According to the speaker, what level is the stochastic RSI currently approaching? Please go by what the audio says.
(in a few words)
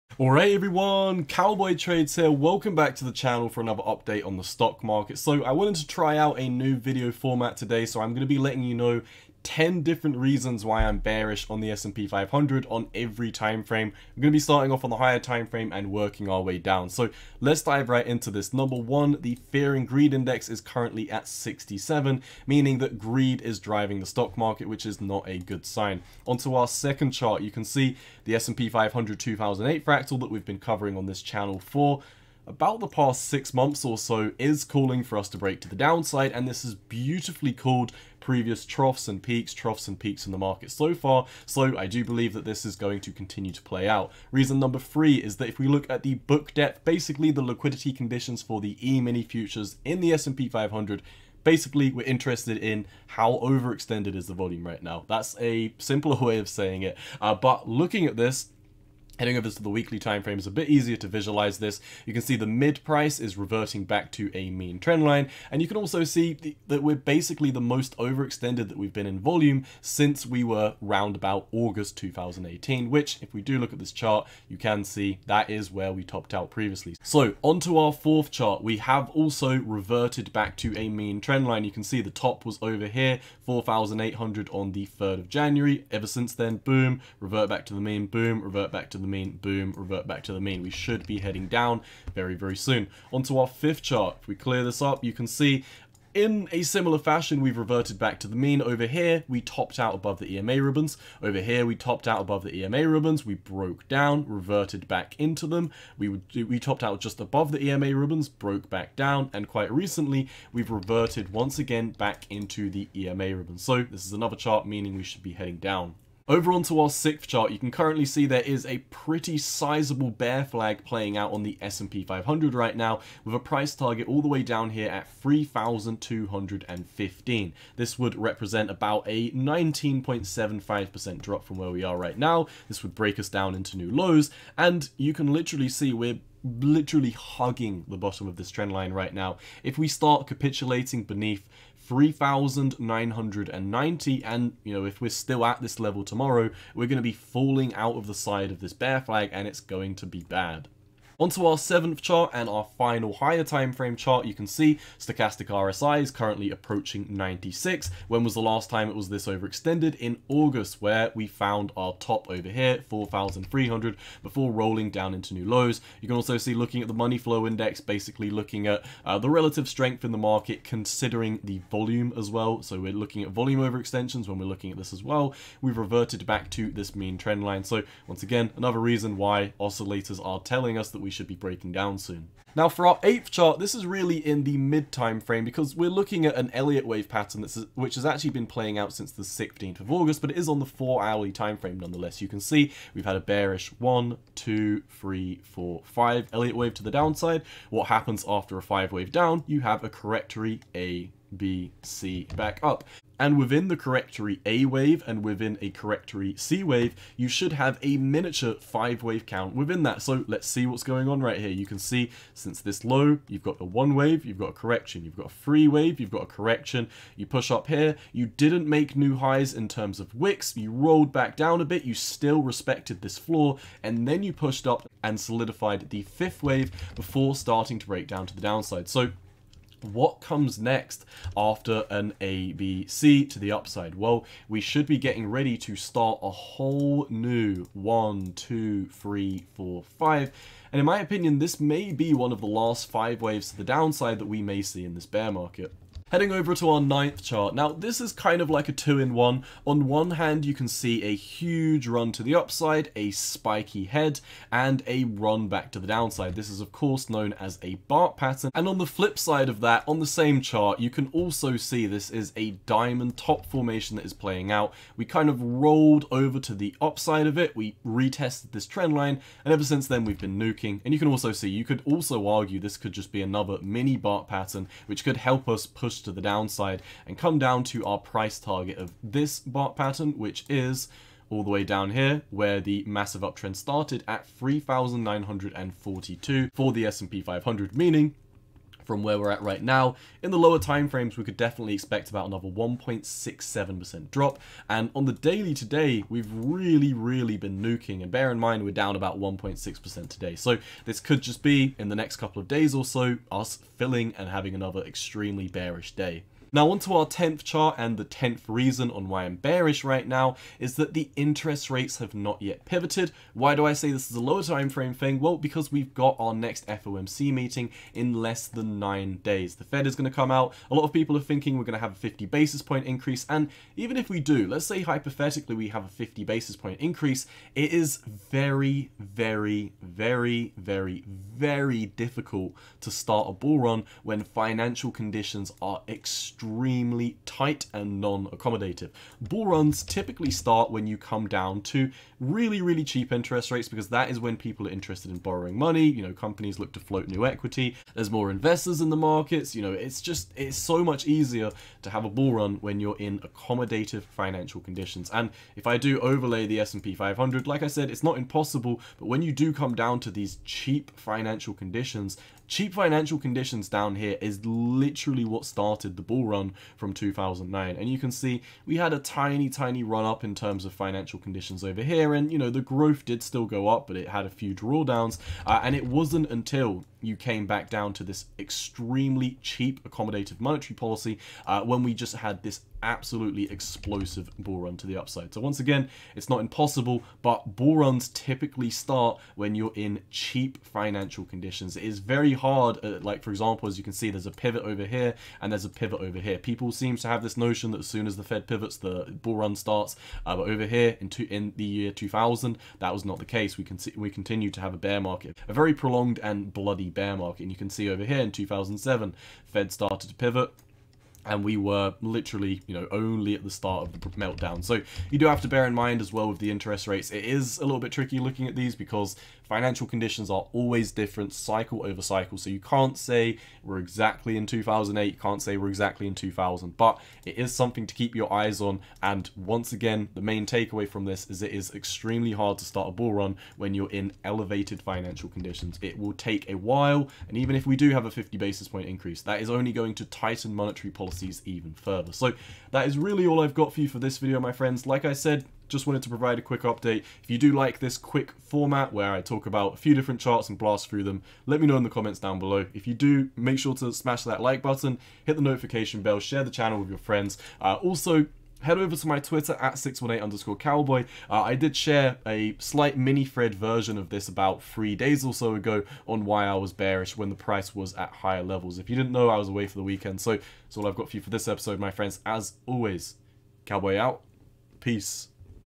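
96.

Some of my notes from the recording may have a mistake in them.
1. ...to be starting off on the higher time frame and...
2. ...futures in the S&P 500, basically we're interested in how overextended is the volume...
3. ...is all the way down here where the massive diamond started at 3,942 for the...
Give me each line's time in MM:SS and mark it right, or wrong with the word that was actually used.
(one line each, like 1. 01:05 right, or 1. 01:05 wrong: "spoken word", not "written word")
1. 00:14 right
2. 00:49 right
3. 04:40 wrong: "uptrend", not "diamond".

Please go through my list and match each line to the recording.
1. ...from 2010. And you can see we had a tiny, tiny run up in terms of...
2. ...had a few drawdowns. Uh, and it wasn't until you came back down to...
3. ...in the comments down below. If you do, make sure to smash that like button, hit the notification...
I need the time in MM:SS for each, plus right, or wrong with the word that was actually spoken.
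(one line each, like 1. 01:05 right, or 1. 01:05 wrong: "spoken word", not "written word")
1. 06:06 wrong: "2009", not "2010"
2. 06:14 right
3. 07:31 right.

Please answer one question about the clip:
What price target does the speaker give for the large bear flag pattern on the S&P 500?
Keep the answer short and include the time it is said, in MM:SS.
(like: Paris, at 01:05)
3,215, at 02:05.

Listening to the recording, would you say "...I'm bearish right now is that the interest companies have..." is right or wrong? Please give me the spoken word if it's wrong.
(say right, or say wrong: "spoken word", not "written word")
wrong: "rates", not "companies".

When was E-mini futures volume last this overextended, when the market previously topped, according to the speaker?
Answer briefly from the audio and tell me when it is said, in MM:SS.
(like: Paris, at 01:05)
August 2018, at 01:11.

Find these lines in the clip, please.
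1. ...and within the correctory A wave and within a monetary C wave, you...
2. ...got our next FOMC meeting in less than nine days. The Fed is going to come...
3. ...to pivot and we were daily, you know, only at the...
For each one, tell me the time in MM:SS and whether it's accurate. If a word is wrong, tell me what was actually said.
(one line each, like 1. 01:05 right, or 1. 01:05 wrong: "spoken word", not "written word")
1. 03:23 wrong: "correctory", not "monetary"
2. 05:15 right
3. 06:50 wrong: "literally", not "daily".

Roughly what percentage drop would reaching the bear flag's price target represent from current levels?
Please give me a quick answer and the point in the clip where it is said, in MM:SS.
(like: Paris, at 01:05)
19.75%, at 02:09.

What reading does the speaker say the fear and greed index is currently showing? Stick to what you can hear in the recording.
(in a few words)
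67.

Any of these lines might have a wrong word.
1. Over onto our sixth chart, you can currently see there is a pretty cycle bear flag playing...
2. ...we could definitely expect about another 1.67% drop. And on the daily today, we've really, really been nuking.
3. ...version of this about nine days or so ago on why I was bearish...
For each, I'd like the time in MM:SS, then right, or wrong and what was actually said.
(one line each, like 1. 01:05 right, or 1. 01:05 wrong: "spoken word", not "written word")
1. 01:56 wrong: "sizable", not "cycle"
2. 04:51 right
3. 07:43 wrong: "three", not "nine".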